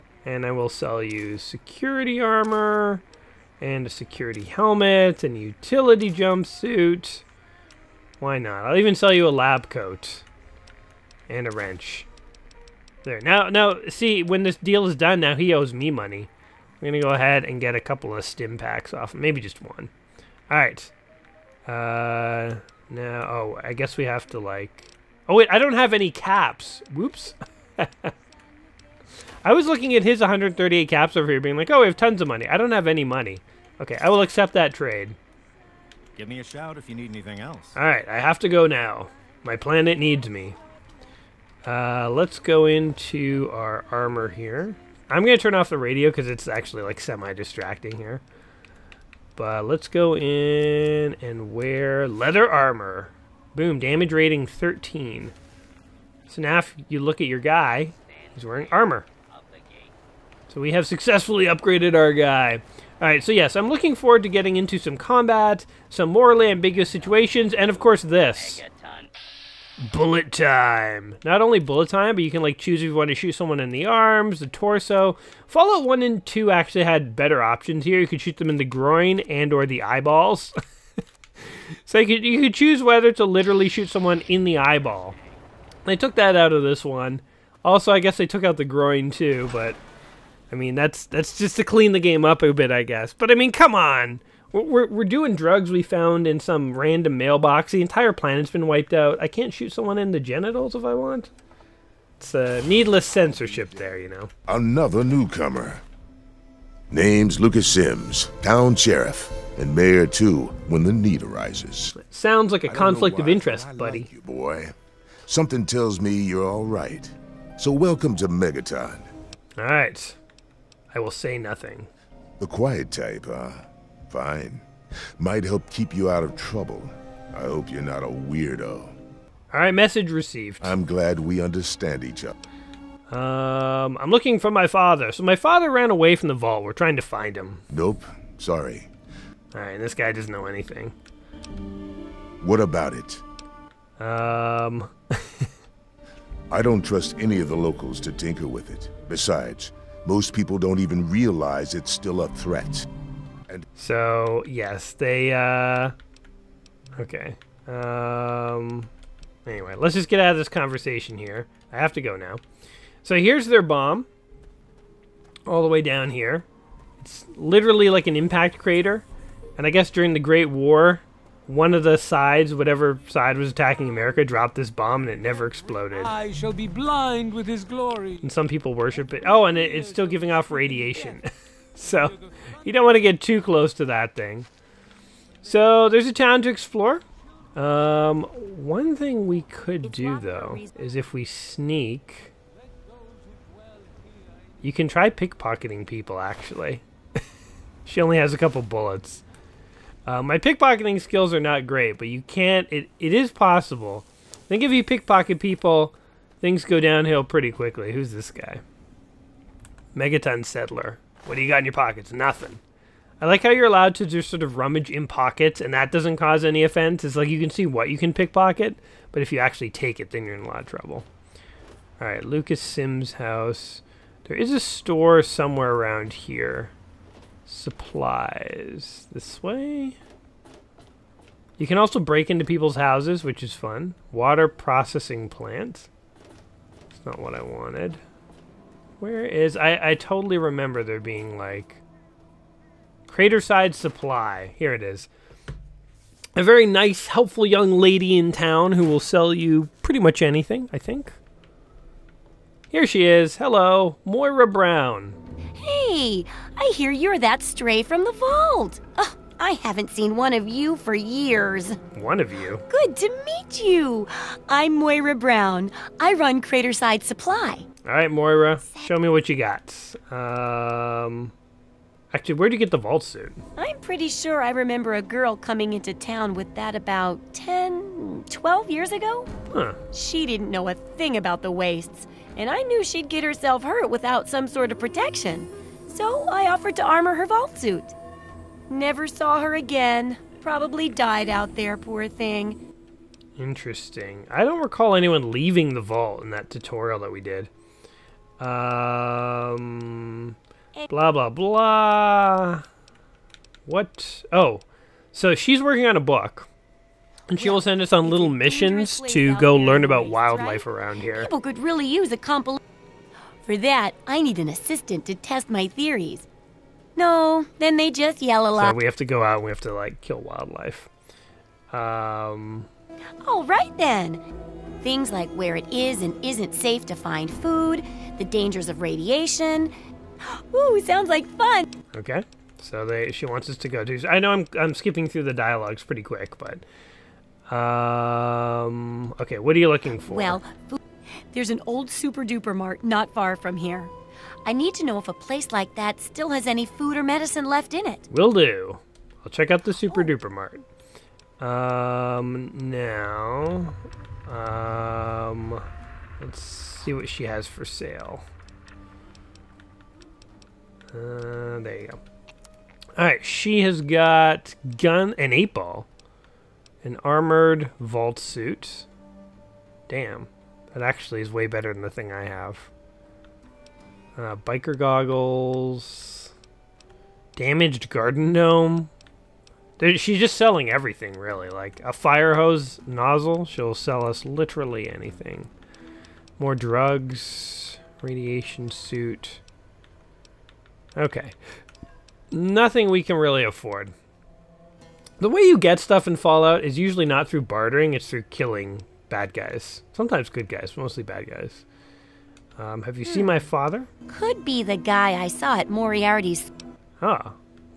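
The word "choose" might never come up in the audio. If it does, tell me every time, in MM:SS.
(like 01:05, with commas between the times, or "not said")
01:12, 01:22.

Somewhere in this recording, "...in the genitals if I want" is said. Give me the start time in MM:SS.
01:39.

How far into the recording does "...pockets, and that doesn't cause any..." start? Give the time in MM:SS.
03:35.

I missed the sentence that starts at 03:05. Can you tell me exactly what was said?
So there's a town to explore.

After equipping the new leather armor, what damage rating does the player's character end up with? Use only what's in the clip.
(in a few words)
13.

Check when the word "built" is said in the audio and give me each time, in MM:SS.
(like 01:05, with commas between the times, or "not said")
not said.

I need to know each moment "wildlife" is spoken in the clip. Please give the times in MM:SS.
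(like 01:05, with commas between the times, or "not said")
05:10, 05:20.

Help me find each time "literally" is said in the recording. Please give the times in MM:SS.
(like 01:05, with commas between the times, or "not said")
01:23, 02:47, 06:24.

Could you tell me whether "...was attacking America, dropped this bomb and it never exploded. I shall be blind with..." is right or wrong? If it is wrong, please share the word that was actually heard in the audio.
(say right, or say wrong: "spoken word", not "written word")
right.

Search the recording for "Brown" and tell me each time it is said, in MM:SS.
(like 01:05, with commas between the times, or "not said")
04:14, 04:25.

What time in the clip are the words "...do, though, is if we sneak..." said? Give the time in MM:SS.
03:09.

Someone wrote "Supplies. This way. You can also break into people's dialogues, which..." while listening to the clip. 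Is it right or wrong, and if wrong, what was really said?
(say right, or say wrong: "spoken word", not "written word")
wrong: "houses", not "dialogues".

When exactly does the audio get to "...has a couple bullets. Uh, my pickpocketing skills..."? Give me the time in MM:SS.
03:18.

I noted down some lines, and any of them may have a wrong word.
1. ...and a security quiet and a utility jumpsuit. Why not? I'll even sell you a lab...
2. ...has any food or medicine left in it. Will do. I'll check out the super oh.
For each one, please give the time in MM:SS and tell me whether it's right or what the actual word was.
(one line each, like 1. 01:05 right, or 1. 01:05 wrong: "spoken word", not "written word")
1. 00:03 wrong: "helmet", not "quiet"
2. 05:46 right.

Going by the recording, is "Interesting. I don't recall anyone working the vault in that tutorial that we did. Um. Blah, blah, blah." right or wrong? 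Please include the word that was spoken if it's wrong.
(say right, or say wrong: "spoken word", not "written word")
wrong: "leaving", not "working".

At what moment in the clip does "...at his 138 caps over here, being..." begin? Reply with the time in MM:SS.
00:29.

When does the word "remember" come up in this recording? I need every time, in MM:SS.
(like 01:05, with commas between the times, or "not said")
04:00, 04:34.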